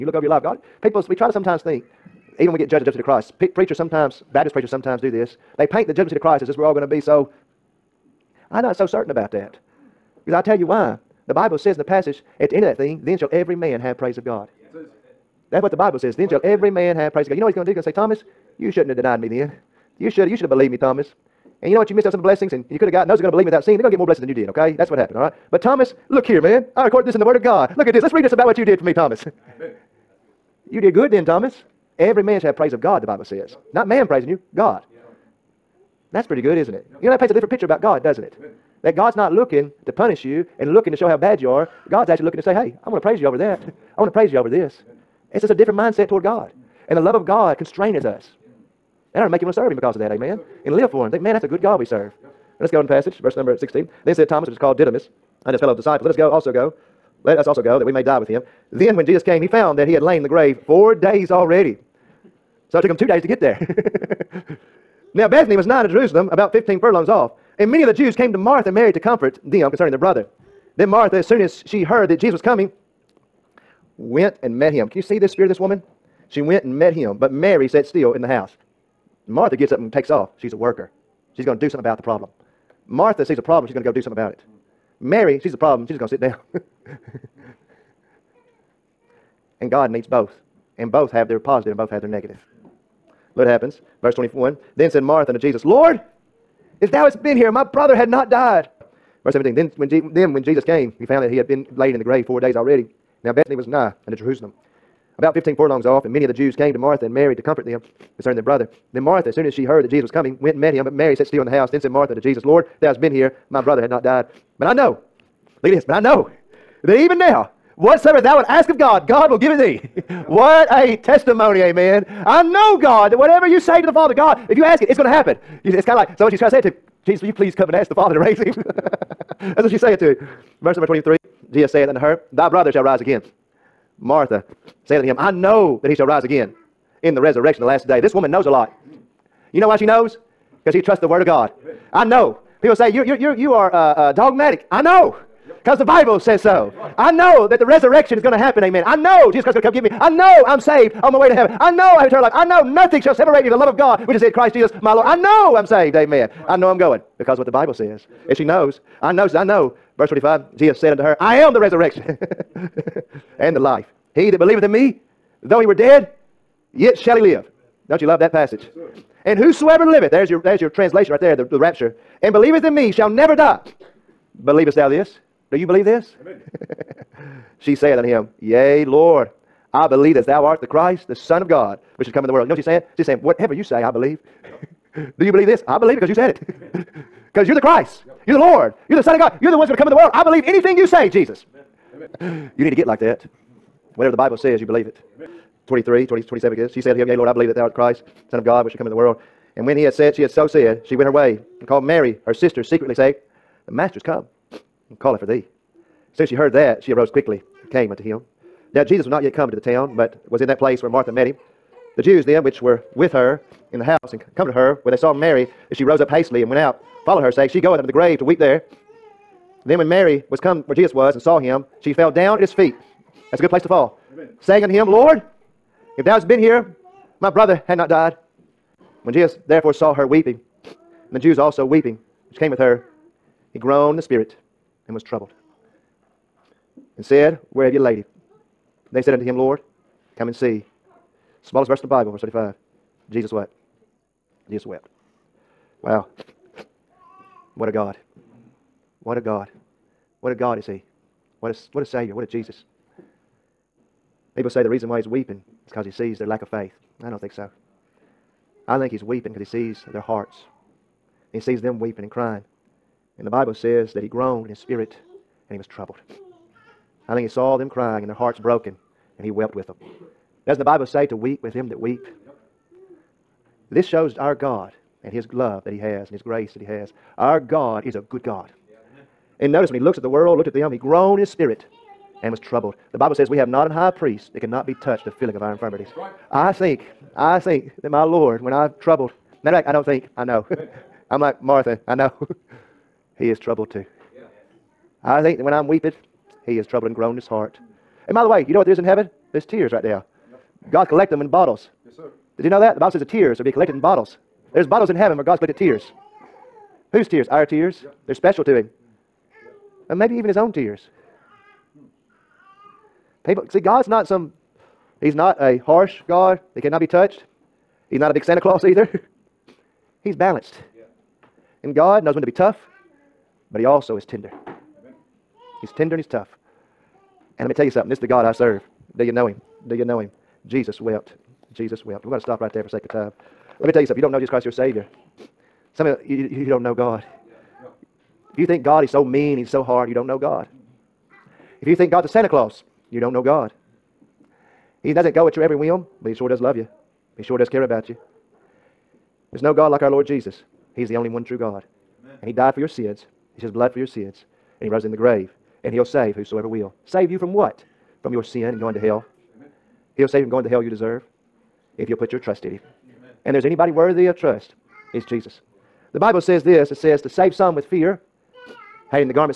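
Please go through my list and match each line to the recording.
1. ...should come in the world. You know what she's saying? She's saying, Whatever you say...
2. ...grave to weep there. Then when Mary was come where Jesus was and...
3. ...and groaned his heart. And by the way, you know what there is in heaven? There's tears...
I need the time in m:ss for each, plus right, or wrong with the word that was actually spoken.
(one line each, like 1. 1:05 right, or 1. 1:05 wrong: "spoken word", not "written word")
1. 3:02 right
2. 3:37 right
3. 4:56 right.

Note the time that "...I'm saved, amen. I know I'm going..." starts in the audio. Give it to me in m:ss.
2:35.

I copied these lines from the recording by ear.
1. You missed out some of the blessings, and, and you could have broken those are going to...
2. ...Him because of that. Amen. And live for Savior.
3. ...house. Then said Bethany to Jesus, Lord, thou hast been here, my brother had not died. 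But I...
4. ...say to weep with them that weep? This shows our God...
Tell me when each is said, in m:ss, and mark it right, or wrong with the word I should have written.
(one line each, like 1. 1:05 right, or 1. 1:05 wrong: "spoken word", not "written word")
1. 0:21 wrong: "gotten", not "broken"
2. 0:49 wrong: "Him", not "Savior"
3. 1:51 wrong: "Martha", not "Bethany"
4. 4:30 right.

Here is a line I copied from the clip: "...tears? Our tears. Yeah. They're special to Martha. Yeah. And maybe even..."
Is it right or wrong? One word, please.
wrong.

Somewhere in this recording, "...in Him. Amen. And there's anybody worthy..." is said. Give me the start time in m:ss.
6:02.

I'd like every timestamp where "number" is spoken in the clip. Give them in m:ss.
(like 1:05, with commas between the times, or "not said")
0:53, 2:10.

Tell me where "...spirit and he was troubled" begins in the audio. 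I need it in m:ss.
4:24.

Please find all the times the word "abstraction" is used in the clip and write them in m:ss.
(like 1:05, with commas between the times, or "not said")
not said.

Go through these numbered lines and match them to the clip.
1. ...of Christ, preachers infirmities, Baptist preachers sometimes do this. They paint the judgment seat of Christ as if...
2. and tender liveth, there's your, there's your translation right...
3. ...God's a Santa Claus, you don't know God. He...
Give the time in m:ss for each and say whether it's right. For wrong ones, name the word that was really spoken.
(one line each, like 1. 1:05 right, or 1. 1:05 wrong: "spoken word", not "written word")
1. 0:02 wrong: "sometimes", not "infirmities"
2. 2:49 wrong: "whosoever", not "tender"
3. 5:41 right.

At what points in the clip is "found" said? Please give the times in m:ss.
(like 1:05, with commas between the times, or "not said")
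0:59, 1:41.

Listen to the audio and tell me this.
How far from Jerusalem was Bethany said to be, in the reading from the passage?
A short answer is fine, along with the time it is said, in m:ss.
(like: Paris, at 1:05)
15 furlongs, at 1:06.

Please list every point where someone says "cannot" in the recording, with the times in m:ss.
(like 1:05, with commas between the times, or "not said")
4:44, 5:16.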